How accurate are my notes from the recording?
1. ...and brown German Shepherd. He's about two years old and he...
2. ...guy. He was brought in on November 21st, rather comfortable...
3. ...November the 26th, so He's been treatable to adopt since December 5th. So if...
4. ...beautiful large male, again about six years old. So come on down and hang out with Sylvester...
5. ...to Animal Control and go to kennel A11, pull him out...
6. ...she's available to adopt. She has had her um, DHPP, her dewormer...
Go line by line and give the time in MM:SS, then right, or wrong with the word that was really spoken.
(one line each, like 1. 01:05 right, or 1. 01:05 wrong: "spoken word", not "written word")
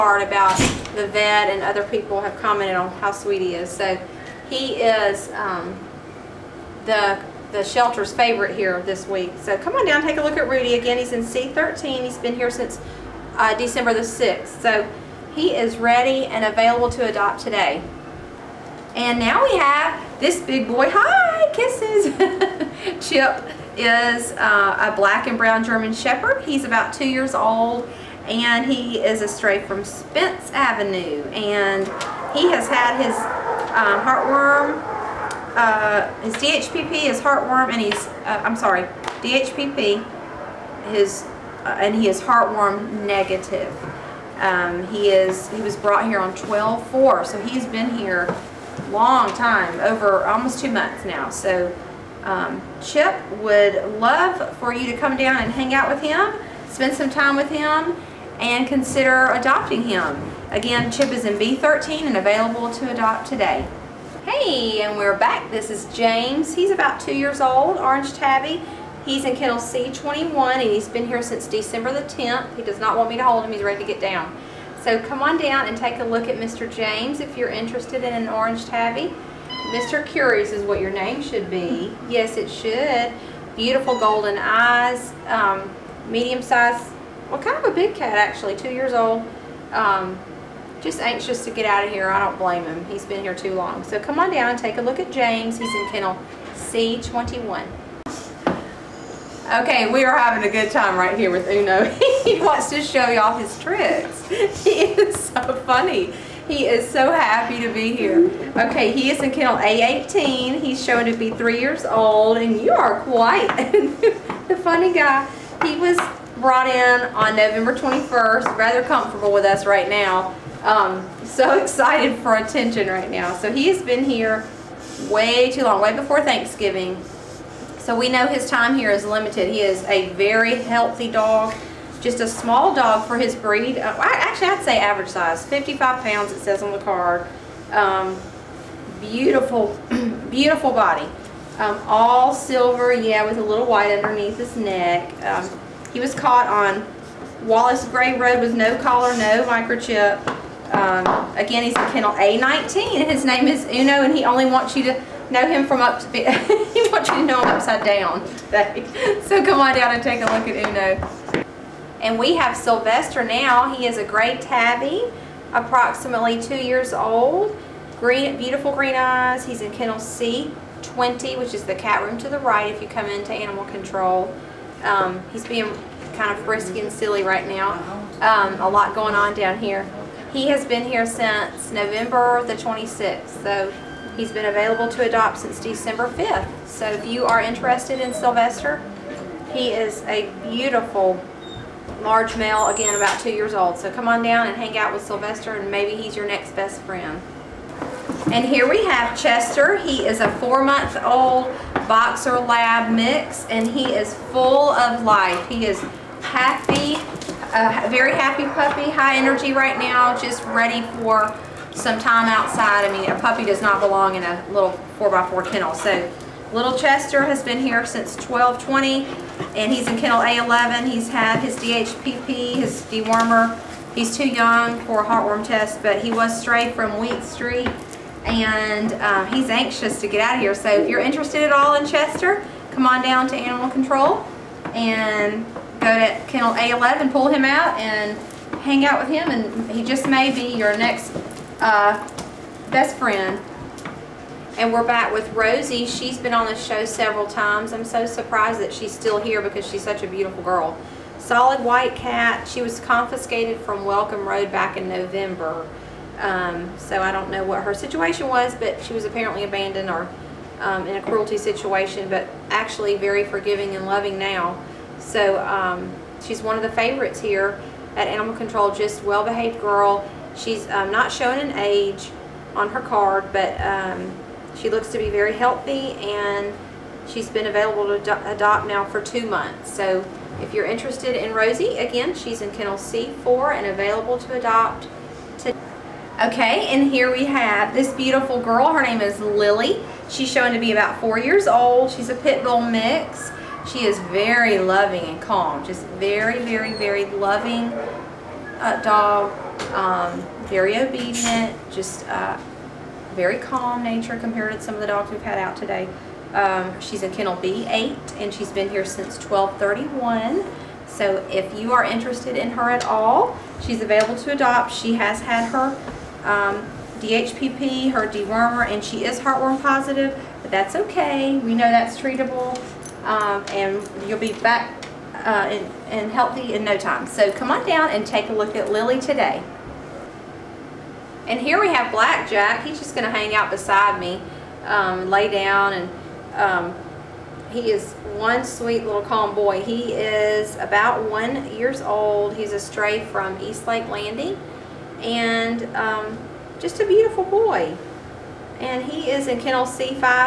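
1. 00:25 right
2. 01:54 right
3. 03:01 wrong: "available", not "treatable"
4. 03:10 wrong: "two", not "six"
5. 03:53 right
6. 05:13 right.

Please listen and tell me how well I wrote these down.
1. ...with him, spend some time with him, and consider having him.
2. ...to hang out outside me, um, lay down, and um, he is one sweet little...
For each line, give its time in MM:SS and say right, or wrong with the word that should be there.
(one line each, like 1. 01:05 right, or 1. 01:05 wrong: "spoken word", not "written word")
1. 00:55 wrong: "adopting", not "having"
2. 05:33 wrong: "beside", not "outside".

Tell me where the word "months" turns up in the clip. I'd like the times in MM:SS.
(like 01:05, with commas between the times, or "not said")
00:50, 03:20, 04:39.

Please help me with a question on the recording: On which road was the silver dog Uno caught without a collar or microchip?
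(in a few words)
Wallace Gray Road.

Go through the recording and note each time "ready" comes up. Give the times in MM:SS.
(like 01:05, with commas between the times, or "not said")
00:15, 01:13, 03:30.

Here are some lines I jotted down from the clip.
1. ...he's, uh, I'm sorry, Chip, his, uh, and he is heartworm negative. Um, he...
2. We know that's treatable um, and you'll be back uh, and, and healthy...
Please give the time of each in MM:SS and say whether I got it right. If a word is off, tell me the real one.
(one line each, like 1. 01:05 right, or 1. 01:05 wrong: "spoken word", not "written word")
1. 00:37 wrong: "DHPP", not "Chip"
2. 05:21 right.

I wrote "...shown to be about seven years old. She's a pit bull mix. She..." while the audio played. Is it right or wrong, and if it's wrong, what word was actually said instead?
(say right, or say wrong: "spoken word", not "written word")
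wrong: "four", not "seven".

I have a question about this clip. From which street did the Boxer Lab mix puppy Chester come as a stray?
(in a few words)
Wheat Street.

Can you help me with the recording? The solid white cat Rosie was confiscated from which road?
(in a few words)
Welcome Road.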